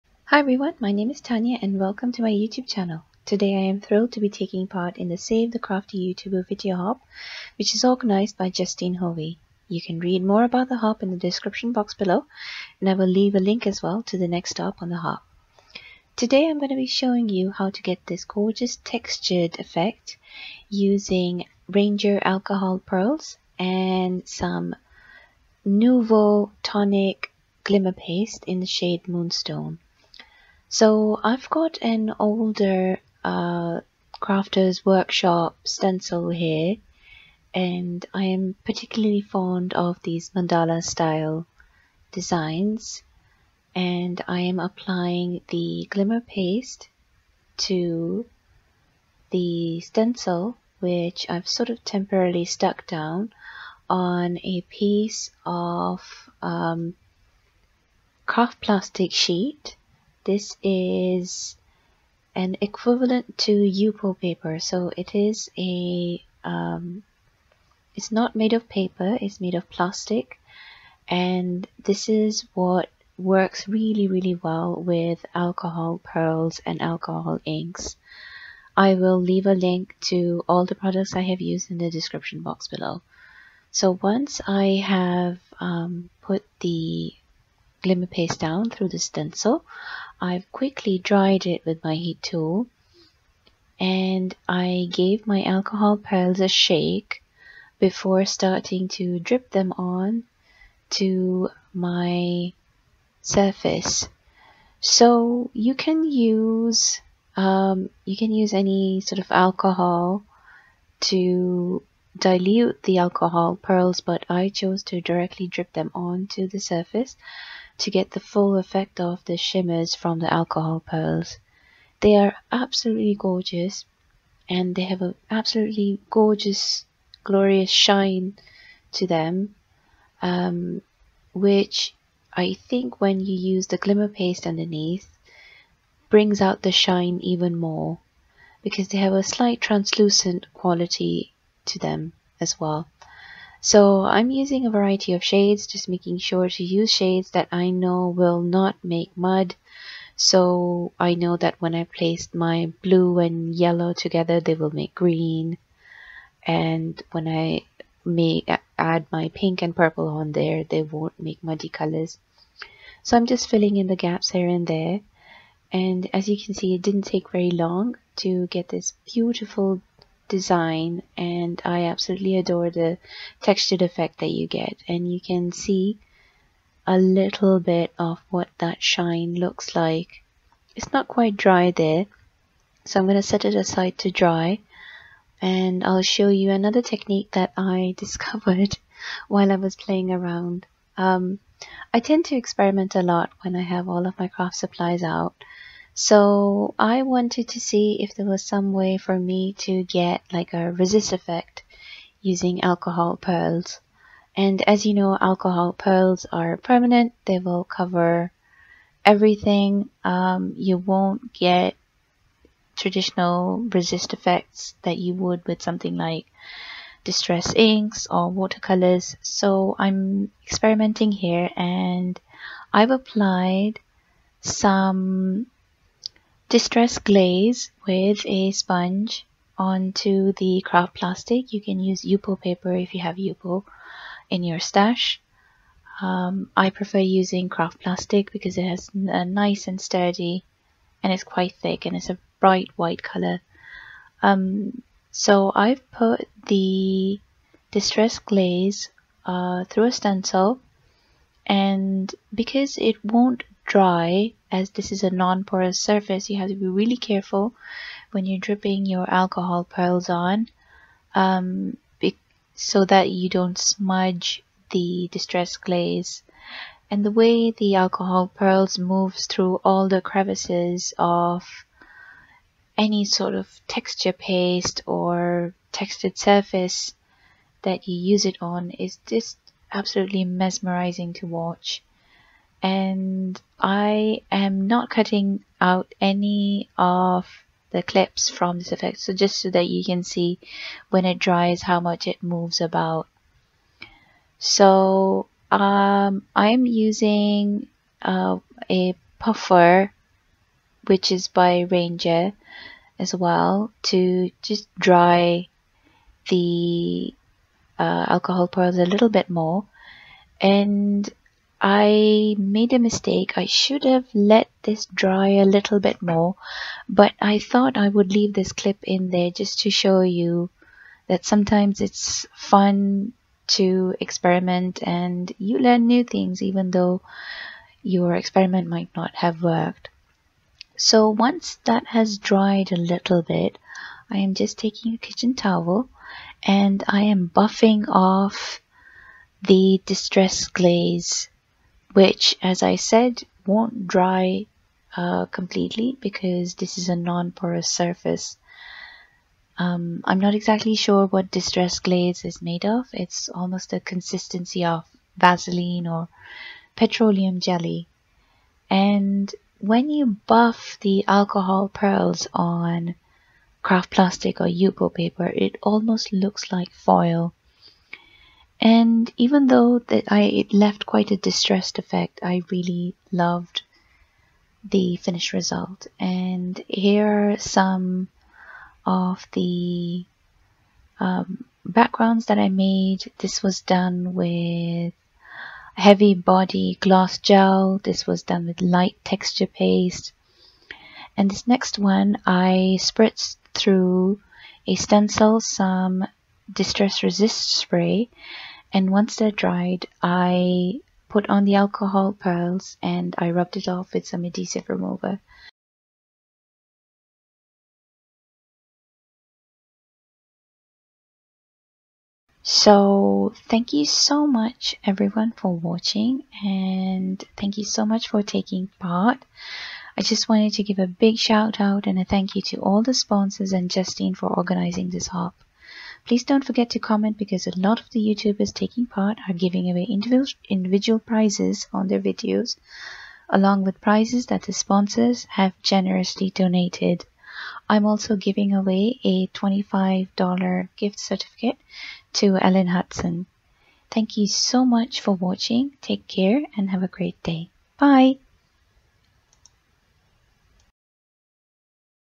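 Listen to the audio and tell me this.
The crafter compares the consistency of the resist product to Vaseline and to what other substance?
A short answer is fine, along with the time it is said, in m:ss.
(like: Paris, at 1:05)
petroleum jelly, at 5:56.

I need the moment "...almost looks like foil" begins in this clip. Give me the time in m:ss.
6:05.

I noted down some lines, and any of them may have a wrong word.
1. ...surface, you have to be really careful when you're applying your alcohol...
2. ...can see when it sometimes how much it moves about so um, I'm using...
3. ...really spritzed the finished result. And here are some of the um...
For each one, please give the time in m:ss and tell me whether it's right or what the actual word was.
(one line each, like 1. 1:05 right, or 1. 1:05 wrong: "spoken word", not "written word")
1. 4:15 wrong: "dripping", not "applying"
2. 4:49 wrong: "dries", not "sometimes"
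3. 6:12 wrong: "loved", not "spritzed".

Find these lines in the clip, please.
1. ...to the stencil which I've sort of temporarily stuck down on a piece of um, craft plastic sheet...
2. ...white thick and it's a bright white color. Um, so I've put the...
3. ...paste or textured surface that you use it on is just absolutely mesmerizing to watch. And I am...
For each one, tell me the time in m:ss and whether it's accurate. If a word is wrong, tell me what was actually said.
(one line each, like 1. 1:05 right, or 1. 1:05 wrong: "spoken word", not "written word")
1. 0:47 right
2. 4:01 wrong: "quite", not "white"
3. 4:34 right.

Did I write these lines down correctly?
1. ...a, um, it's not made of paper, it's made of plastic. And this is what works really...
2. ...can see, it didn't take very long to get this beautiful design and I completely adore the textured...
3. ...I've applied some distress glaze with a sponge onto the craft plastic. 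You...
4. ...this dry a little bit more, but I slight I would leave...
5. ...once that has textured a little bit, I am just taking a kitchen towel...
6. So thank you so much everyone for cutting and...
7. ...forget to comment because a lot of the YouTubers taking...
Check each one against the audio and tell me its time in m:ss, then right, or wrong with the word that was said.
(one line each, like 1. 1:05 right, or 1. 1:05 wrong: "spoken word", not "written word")
1. 1:05 right
2. 2:46 wrong: "absolutely", not "completely"
3. 3:42 right
4. 5:14 wrong: "thought", not "slight"
5. 5:31 wrong: "dried", not "textured"
6. 6:52 wrong: "watching", not "cutting"
7. 7:06 right.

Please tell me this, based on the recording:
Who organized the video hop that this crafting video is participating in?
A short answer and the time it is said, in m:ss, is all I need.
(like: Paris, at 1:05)
Justine Hovey, at 0:08.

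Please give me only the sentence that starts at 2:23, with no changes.
So I'm using a variety of shades, just making sure to use shades that I know will not make mud.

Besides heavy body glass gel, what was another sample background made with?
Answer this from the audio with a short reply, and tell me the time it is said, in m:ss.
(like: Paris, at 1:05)
light texture paste, at 6:28.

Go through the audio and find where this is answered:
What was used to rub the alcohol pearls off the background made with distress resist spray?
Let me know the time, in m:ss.
6:44.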